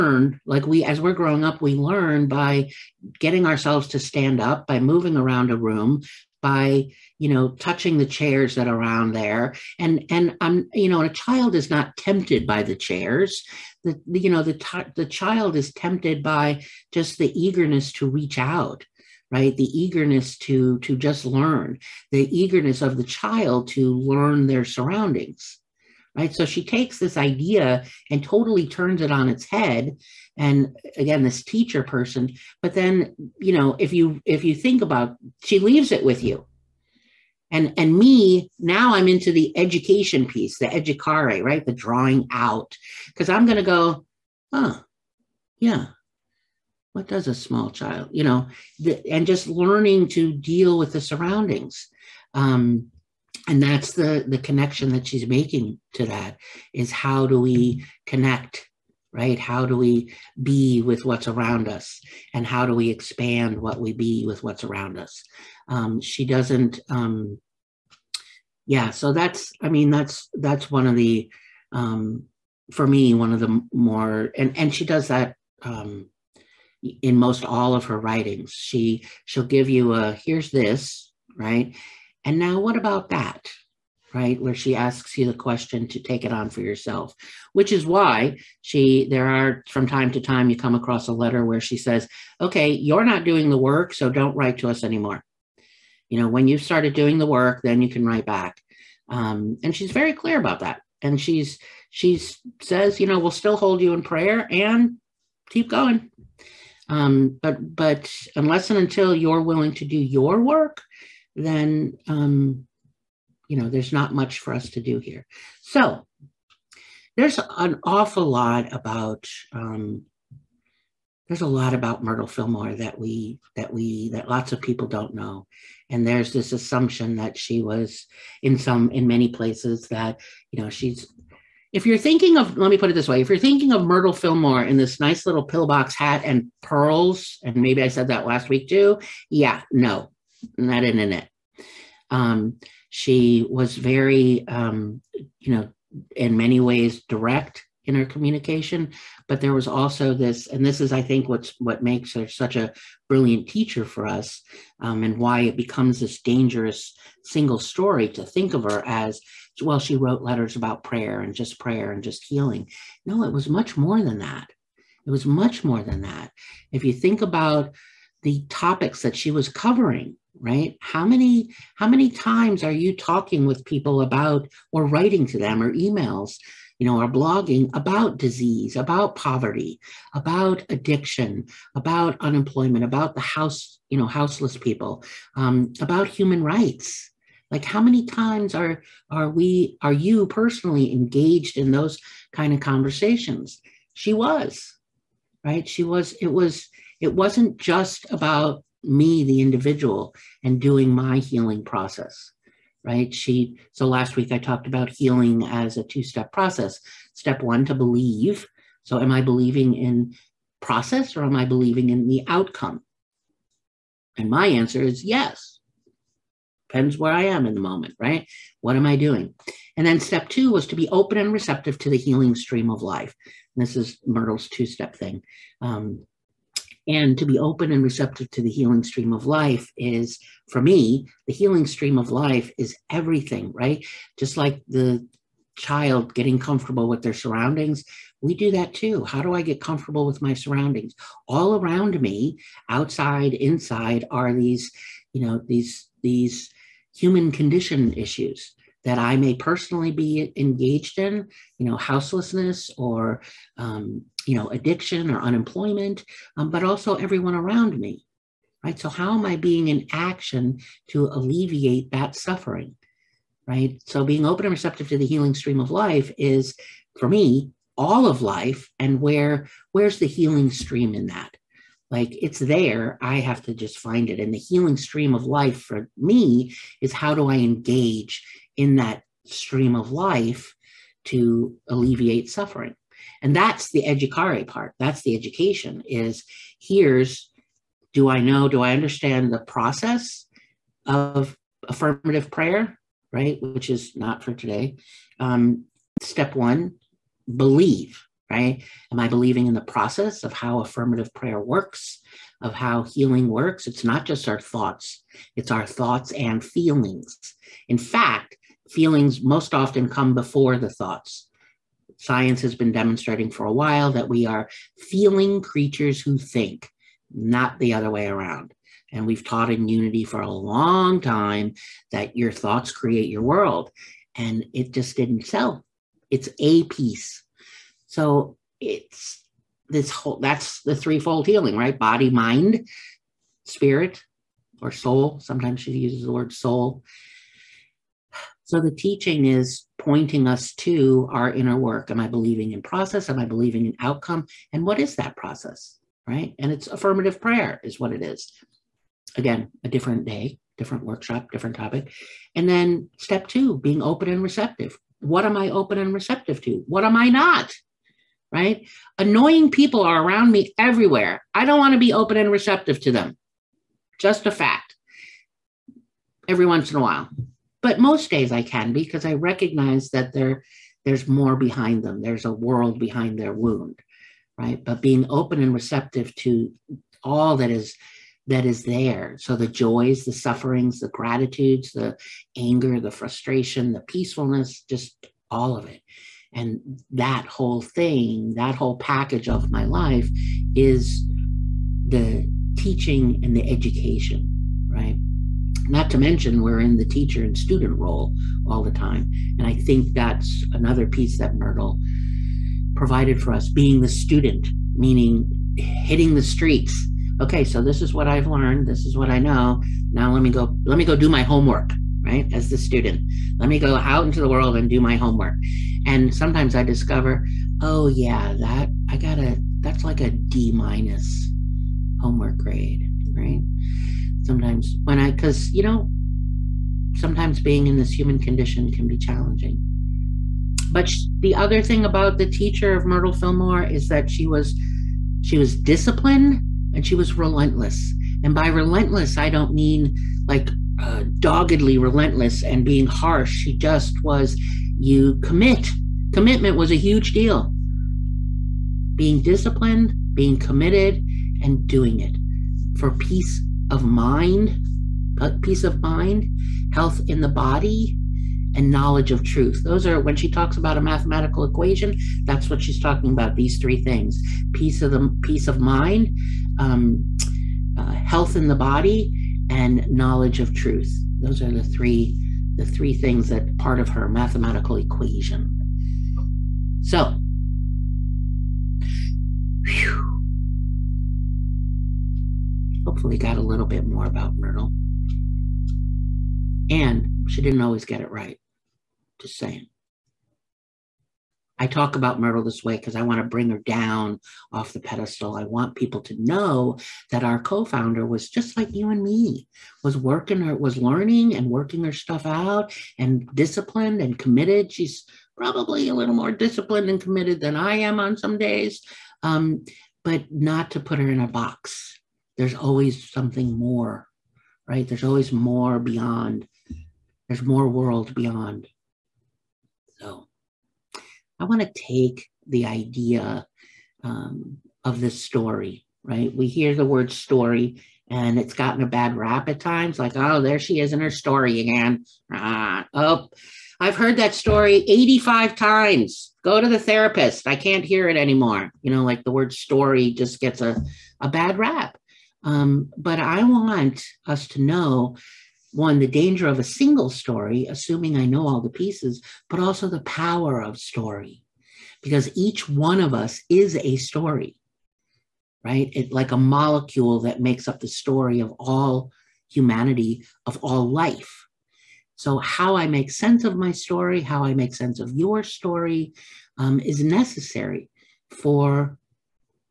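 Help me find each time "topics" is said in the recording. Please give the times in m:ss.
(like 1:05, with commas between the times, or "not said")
2:48, 5:51.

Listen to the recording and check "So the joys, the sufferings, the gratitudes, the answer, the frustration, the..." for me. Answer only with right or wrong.
wrong.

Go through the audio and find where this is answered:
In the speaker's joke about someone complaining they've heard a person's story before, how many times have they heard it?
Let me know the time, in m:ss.
8:54.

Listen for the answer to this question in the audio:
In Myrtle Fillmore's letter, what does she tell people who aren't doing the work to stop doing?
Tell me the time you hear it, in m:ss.
1:34.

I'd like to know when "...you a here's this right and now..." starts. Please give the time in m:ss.
1:19.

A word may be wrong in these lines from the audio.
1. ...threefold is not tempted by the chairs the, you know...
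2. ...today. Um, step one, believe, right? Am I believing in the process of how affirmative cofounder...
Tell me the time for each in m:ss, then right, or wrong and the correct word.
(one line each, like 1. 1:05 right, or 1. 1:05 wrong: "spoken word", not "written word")
1. 0:11 wrong: "child", not "threefold"
2. 4:54 wrong: "prayer", not "cofounder".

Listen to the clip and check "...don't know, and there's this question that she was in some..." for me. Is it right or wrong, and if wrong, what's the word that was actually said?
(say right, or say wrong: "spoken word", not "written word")
wrong: "assumption", not "question".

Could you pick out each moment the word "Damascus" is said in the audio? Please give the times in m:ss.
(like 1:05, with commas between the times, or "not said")
not said.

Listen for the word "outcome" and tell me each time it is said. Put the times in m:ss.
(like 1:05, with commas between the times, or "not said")
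3:32, 5:43.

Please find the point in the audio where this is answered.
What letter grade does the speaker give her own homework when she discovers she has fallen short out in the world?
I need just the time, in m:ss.
7:00.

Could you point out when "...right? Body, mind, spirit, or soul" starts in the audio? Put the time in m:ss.
5:31.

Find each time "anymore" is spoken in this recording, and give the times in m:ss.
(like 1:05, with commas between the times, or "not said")
1:34, 8:58.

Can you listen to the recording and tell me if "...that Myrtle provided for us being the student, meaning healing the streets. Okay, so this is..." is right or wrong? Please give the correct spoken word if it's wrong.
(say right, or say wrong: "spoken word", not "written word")
wrong: "hitting", not "healing".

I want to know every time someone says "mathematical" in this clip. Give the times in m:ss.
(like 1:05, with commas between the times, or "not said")
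7:40, 7:54.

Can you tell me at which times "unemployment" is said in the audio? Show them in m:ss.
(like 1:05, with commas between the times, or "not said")
3:02, 4:15.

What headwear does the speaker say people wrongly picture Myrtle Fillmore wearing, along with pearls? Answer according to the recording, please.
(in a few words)
pillbox hat.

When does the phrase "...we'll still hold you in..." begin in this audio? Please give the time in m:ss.
1:43.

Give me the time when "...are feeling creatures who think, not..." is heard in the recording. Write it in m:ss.
5:14.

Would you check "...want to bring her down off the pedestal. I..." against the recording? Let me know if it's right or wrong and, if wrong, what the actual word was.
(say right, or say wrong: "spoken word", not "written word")
right.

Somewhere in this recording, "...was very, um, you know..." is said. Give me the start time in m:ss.
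2:23.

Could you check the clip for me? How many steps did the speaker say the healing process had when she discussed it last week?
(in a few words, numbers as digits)
2.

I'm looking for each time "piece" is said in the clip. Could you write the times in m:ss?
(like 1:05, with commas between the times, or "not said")
0:40, 5:26, 6:40, 9:08.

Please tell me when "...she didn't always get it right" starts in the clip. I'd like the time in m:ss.
8:07.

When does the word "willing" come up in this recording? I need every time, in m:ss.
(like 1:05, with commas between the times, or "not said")
1:49.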